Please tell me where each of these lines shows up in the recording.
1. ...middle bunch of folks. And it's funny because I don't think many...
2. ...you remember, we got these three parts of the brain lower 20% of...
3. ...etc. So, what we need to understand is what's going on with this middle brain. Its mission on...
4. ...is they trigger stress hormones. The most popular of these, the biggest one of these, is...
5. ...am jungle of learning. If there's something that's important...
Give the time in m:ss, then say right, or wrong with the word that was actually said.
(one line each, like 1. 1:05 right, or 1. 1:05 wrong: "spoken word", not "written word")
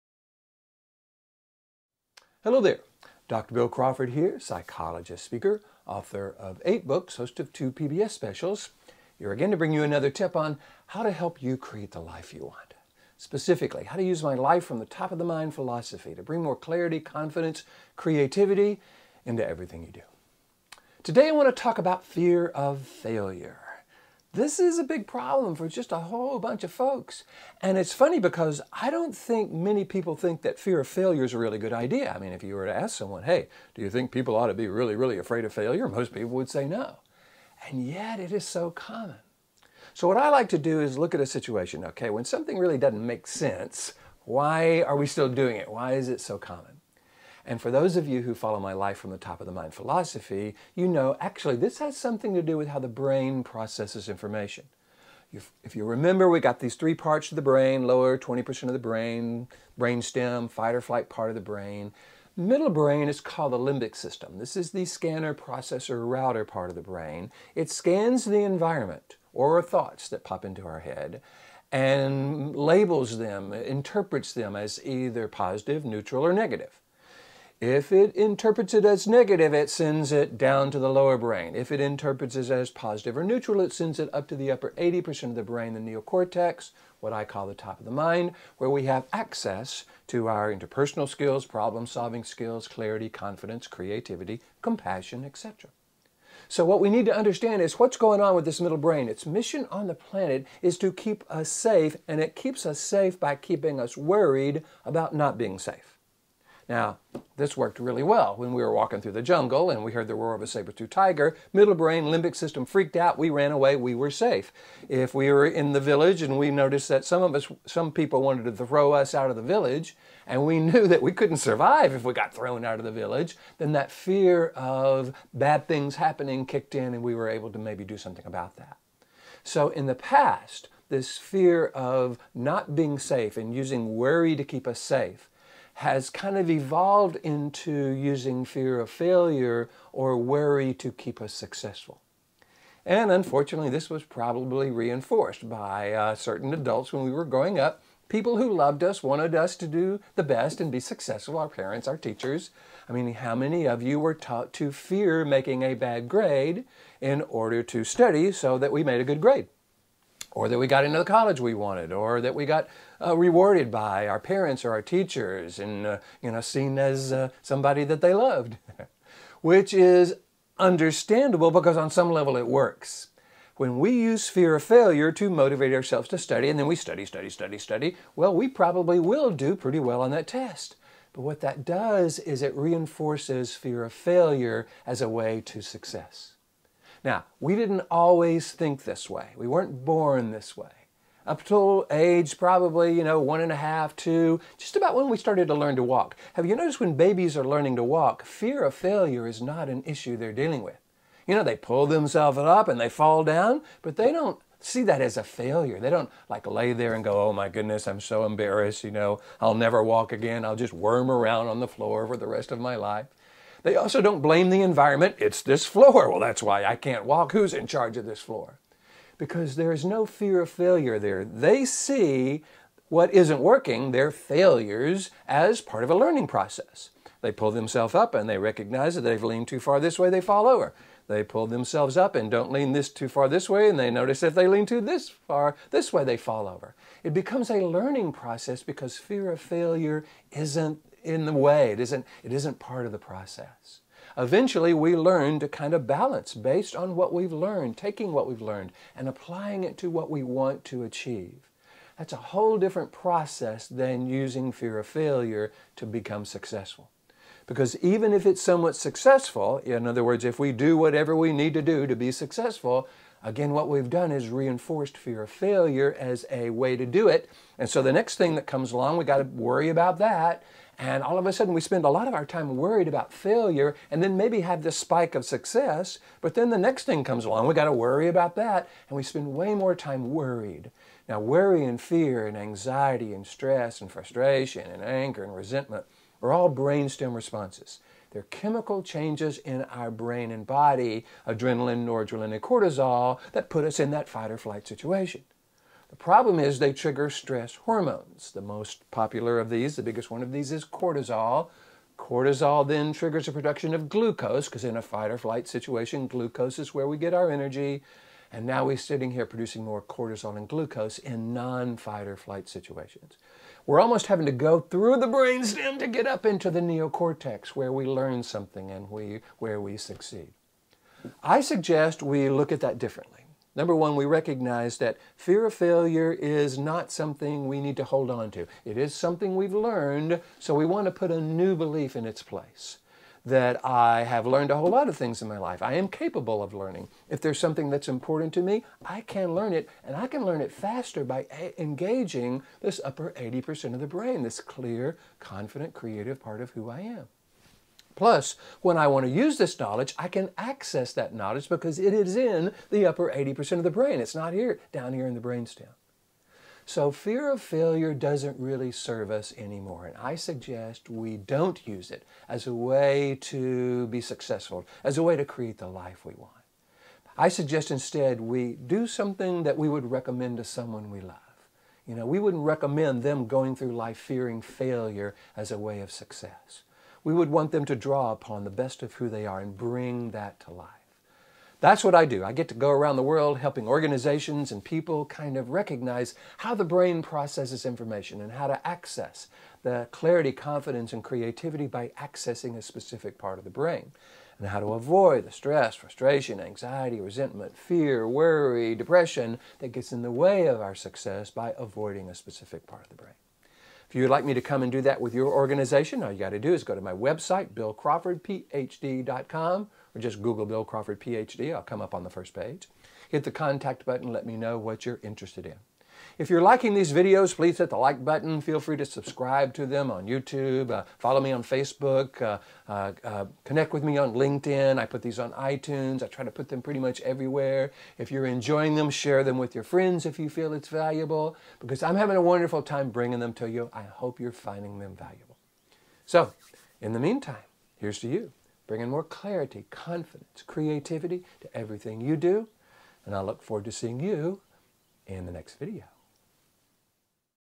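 1. 0:25 wrong: "whole", not "middle"
2. 0:55 right
3. 1:35 right
4. 4:56 right
5. 5:35 wrong: "capable", not "jungle".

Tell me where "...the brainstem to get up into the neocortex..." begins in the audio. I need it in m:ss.
5:14.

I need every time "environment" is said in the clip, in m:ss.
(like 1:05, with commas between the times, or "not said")
1:08, 3:34.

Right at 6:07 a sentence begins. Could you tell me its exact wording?
I suggest instead we do something that we would recommend to someone we love.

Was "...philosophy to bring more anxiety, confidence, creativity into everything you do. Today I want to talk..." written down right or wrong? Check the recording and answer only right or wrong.
wrong.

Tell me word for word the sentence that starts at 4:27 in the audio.
And so the next thing that comes along, we got to worry about that.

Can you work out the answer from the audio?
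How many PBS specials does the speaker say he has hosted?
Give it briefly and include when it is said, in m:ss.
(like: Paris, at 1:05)
2, at 0:07.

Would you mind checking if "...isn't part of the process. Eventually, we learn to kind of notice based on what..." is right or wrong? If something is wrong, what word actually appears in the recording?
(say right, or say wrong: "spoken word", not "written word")
wrong: "balance", not "notice".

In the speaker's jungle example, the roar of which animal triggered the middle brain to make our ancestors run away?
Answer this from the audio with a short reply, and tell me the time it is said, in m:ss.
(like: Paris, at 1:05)
saber-toothed tiger, at 1:50.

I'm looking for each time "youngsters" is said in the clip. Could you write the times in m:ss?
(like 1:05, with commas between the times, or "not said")
not said.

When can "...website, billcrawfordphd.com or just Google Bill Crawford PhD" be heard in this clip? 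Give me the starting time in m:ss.
6:46.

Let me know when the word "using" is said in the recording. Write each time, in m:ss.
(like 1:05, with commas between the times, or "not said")
2:13, 2:17, 4:14.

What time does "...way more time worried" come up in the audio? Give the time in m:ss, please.
4:39.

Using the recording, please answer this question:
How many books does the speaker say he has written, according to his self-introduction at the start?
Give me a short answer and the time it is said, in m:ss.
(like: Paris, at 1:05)
8, at 0:06.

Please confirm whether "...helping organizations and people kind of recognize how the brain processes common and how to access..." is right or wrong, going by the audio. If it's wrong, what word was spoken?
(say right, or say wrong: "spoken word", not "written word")
wrong: "information", not "common".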